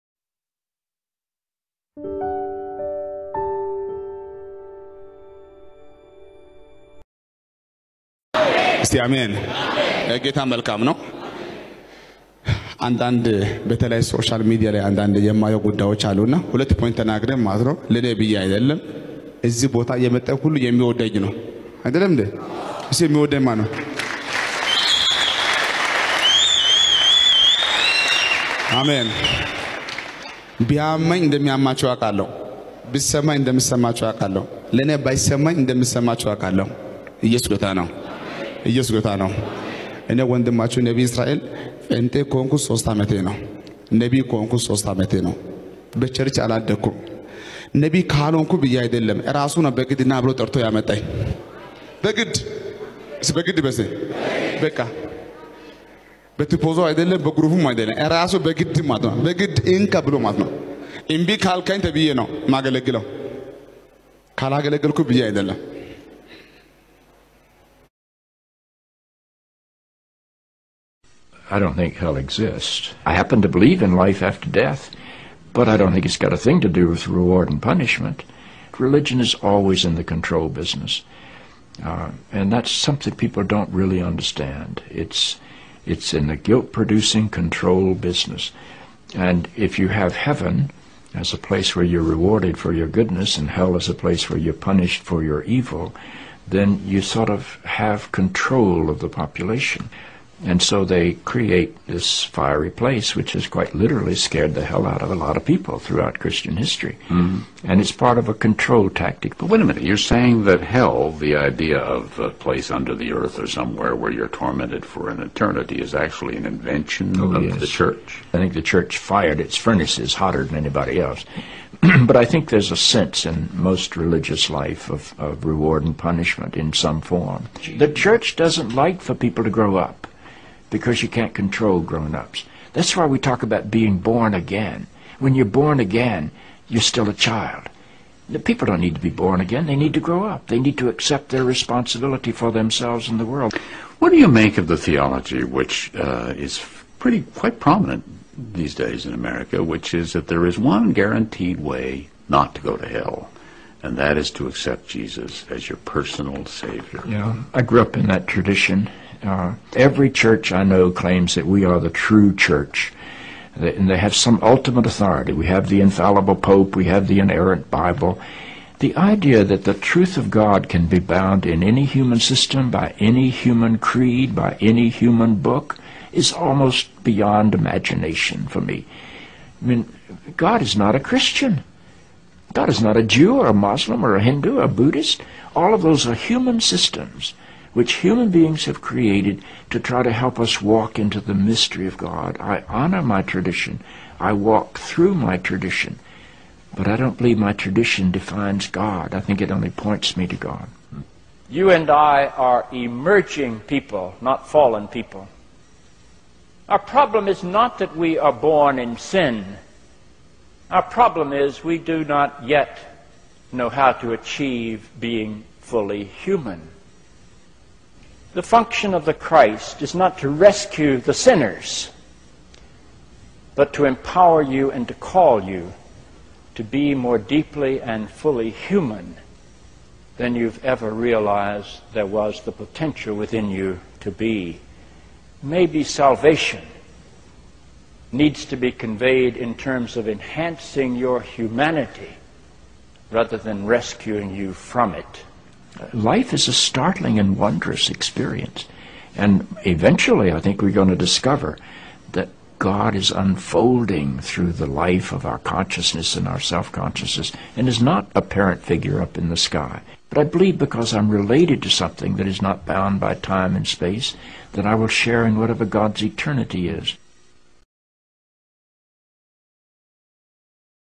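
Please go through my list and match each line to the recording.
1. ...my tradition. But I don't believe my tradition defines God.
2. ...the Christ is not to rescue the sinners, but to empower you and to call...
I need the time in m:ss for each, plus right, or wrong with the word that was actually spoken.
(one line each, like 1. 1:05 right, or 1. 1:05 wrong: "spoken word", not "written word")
1. 3:15 right
2. 3:39 right.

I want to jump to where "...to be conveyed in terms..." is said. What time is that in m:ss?
3:58.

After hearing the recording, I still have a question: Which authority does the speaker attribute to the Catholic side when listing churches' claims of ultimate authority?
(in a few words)
the infallible Pope.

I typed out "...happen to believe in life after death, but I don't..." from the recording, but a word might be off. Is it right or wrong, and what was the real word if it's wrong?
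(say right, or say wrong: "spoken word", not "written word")
right.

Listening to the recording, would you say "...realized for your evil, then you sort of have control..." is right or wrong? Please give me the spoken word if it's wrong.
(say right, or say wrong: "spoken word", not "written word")
wrong: "punished", not "realized".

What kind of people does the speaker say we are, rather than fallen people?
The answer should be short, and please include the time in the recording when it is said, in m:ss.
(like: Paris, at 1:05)
emerging people, at 3:22.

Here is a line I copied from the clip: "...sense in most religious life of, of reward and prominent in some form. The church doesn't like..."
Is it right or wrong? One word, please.
wrong.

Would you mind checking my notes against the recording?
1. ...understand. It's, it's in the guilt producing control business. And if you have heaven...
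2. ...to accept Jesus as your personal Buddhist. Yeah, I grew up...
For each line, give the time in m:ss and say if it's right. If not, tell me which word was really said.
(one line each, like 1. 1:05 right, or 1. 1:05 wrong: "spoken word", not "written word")
1. 1:24 right
2. 2:34 wrong: "Savior", not "Buddhist".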